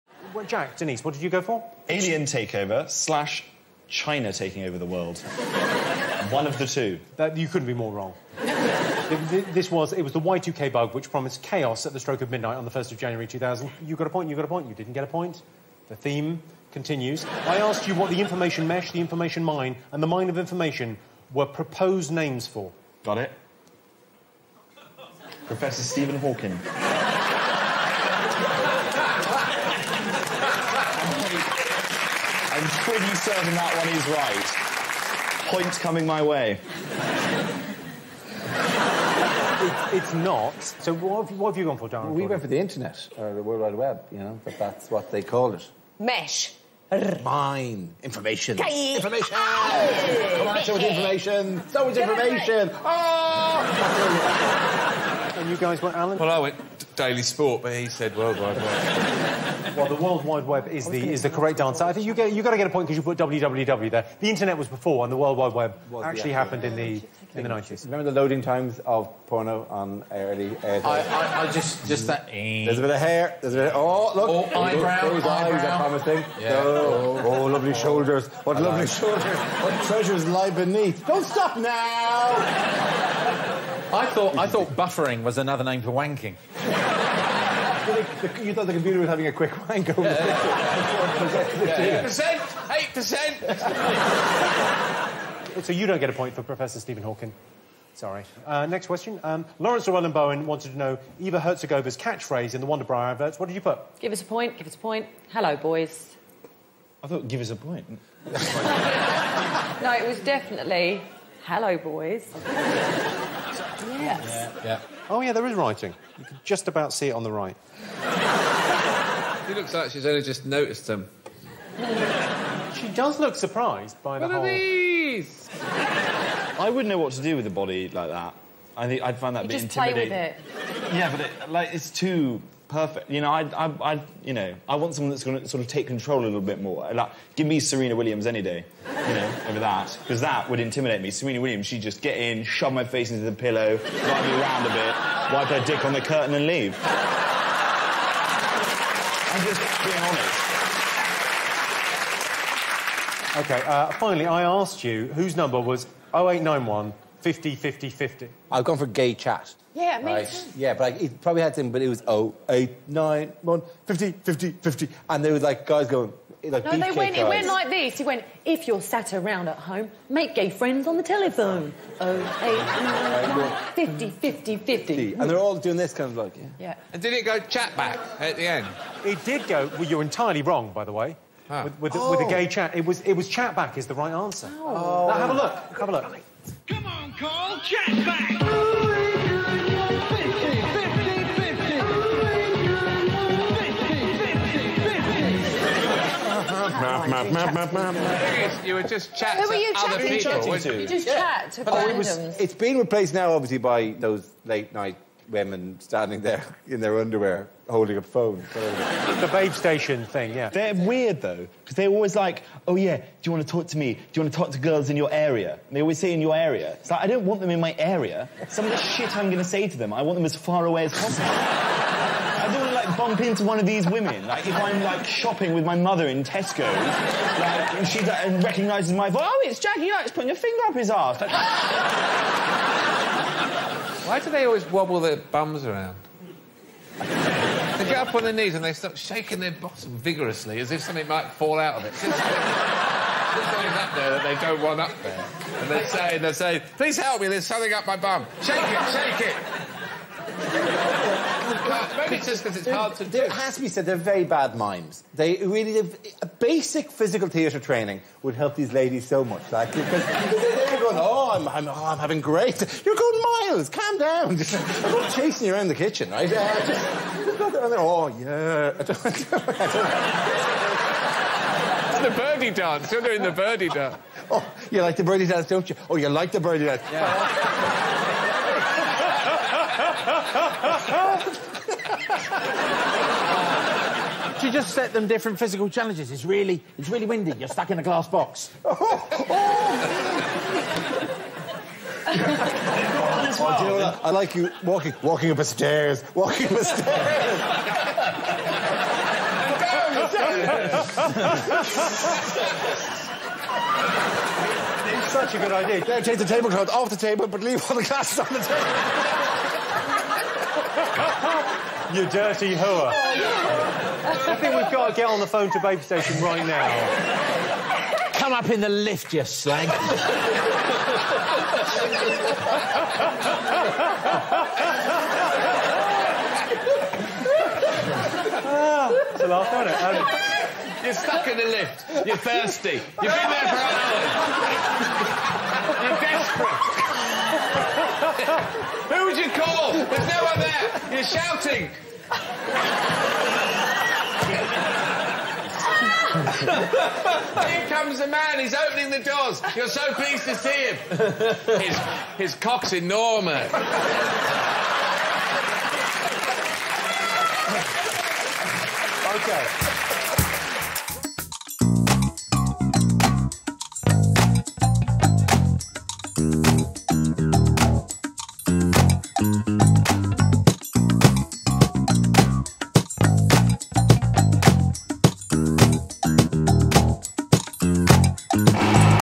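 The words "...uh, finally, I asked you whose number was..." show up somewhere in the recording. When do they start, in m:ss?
2:33.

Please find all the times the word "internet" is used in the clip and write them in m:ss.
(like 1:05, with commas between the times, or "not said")
0:42, 1:04.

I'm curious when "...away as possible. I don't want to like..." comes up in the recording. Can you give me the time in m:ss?
3:40.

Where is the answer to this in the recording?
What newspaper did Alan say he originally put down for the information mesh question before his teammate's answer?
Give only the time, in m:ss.
0:56.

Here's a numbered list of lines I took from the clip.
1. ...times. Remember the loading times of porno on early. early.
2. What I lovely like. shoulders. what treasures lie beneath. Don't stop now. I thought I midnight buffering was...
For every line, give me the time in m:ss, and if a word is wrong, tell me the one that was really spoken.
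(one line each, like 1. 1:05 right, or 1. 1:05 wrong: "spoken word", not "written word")
1. 1:07 wrong: "nineties", not "times"
2. 1:18 wrong: "thought", not "midnight".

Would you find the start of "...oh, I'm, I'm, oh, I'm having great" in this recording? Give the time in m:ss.
4:21.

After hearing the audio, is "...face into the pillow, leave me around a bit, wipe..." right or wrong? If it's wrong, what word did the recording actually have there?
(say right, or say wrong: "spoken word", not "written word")
wrong: "drive", not "leave".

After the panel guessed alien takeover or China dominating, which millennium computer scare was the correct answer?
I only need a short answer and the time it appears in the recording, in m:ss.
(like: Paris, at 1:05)
Y2K bug, at 0:10.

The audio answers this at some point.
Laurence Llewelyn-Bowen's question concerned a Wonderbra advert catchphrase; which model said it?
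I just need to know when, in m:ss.
1:41.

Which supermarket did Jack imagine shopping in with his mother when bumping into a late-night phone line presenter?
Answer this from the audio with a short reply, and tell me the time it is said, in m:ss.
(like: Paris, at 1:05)
Tesco, at 3:46.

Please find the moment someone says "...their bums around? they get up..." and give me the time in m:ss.
3:54.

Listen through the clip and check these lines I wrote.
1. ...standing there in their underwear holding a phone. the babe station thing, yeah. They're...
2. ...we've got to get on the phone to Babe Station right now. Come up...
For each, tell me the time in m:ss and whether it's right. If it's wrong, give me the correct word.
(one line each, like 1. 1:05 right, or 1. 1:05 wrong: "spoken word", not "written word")
1. 3:25 right
2. 5:14 right.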